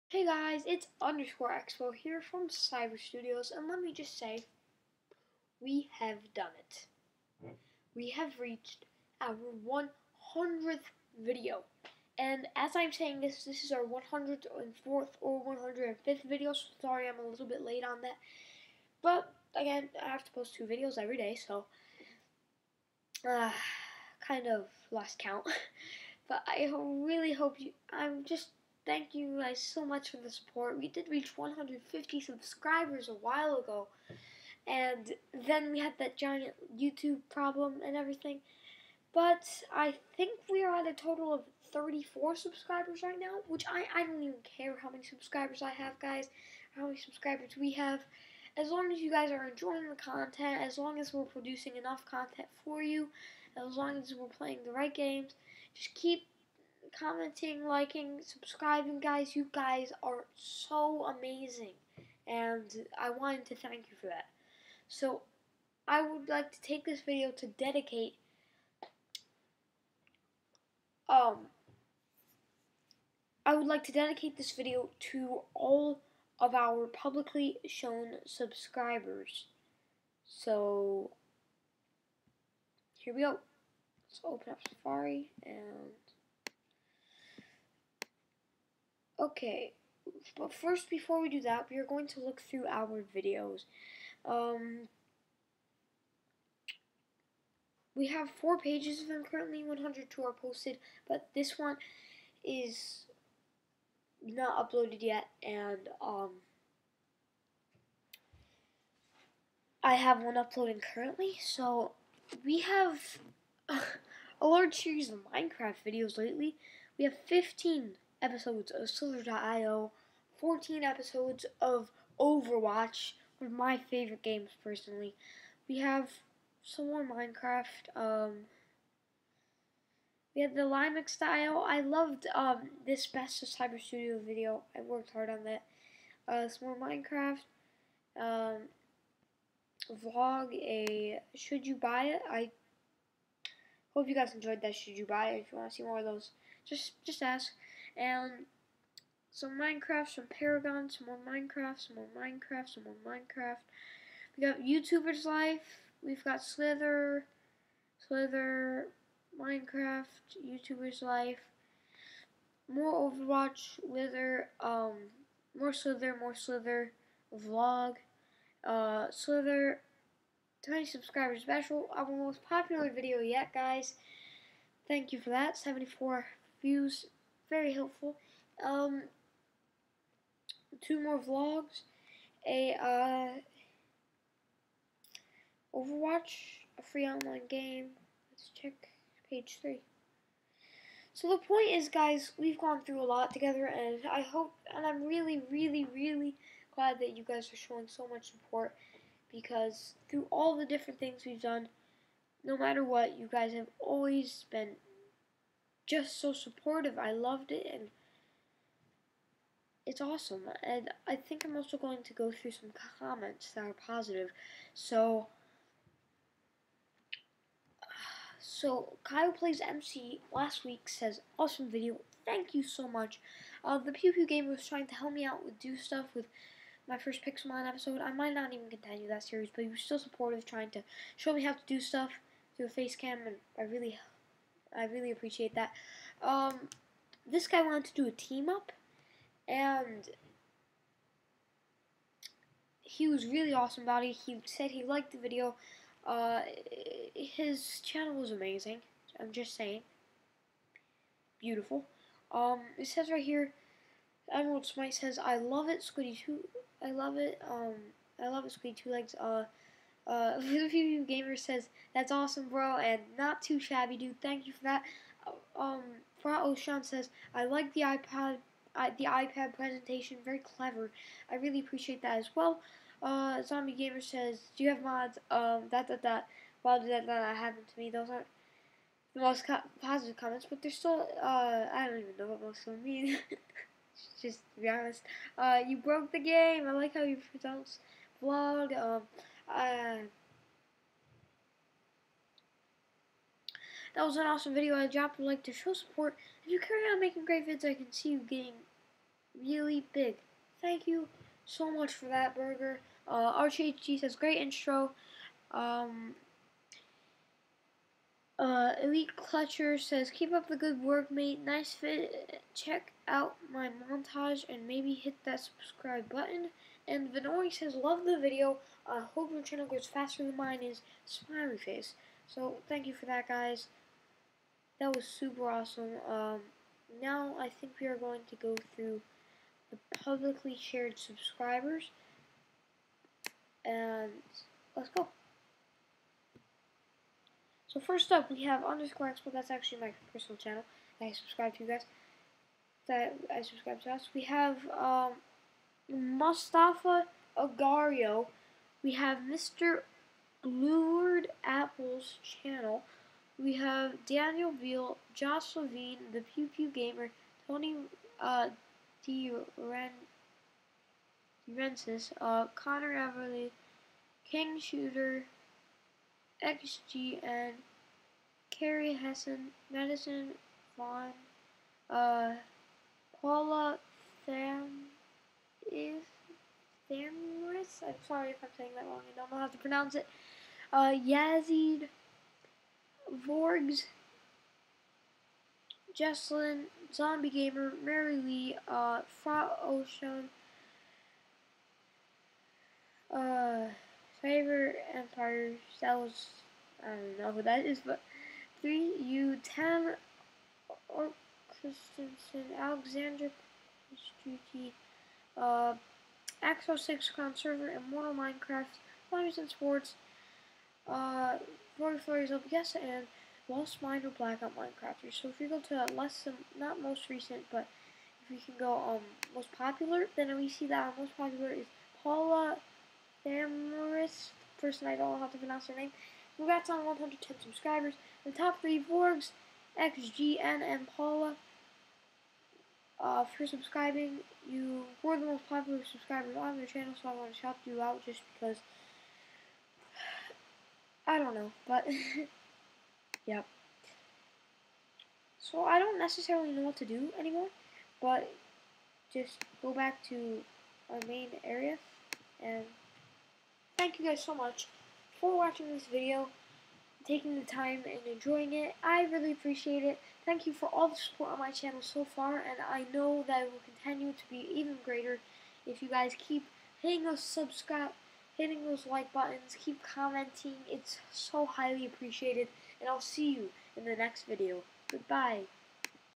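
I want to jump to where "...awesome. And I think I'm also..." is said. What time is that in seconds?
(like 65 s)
209 s.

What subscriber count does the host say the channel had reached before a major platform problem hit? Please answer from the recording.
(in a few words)
150.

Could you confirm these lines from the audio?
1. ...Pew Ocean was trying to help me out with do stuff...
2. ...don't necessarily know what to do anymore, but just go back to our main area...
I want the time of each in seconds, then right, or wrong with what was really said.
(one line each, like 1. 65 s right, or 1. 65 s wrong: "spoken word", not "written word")
1. 224 s wrong: "Gamer", not "Ocean"
2. 445 s right.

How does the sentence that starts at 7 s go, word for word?
We have reached our 100th video.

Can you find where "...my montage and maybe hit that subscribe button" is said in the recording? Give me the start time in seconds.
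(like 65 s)
313 s.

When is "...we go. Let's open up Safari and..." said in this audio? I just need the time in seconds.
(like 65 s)
83 s.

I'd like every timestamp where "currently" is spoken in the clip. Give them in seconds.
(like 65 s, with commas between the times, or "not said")
99 s, 110 s.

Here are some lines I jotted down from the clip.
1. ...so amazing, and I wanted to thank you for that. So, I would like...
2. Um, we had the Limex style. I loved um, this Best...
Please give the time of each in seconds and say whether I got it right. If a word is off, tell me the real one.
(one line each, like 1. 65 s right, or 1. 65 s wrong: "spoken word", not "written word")
1. 60 s right
2. 127 s right.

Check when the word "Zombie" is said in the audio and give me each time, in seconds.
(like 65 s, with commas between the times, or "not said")
273 s, 386 s.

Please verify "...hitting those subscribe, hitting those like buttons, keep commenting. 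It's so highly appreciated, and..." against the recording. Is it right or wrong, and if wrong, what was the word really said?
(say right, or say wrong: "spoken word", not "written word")
right.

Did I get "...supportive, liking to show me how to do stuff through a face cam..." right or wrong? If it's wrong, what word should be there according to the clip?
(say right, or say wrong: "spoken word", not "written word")
wrong: "trying", not "liking".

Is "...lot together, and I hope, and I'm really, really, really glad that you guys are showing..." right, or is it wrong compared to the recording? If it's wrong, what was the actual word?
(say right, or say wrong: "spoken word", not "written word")
right.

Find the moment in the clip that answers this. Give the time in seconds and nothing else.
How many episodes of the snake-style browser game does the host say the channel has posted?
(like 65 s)
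117 s.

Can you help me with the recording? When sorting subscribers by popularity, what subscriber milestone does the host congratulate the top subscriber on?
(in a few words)
110.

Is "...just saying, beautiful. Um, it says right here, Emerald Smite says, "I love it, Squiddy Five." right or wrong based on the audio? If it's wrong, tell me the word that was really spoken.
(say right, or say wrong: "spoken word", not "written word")
wrong: "Two", not "Five".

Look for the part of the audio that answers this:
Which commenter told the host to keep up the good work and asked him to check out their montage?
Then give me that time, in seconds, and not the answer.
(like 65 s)
308 s.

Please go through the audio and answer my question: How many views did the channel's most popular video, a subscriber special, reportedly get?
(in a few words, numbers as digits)
74.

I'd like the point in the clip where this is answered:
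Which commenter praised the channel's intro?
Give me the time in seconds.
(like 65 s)
303 s.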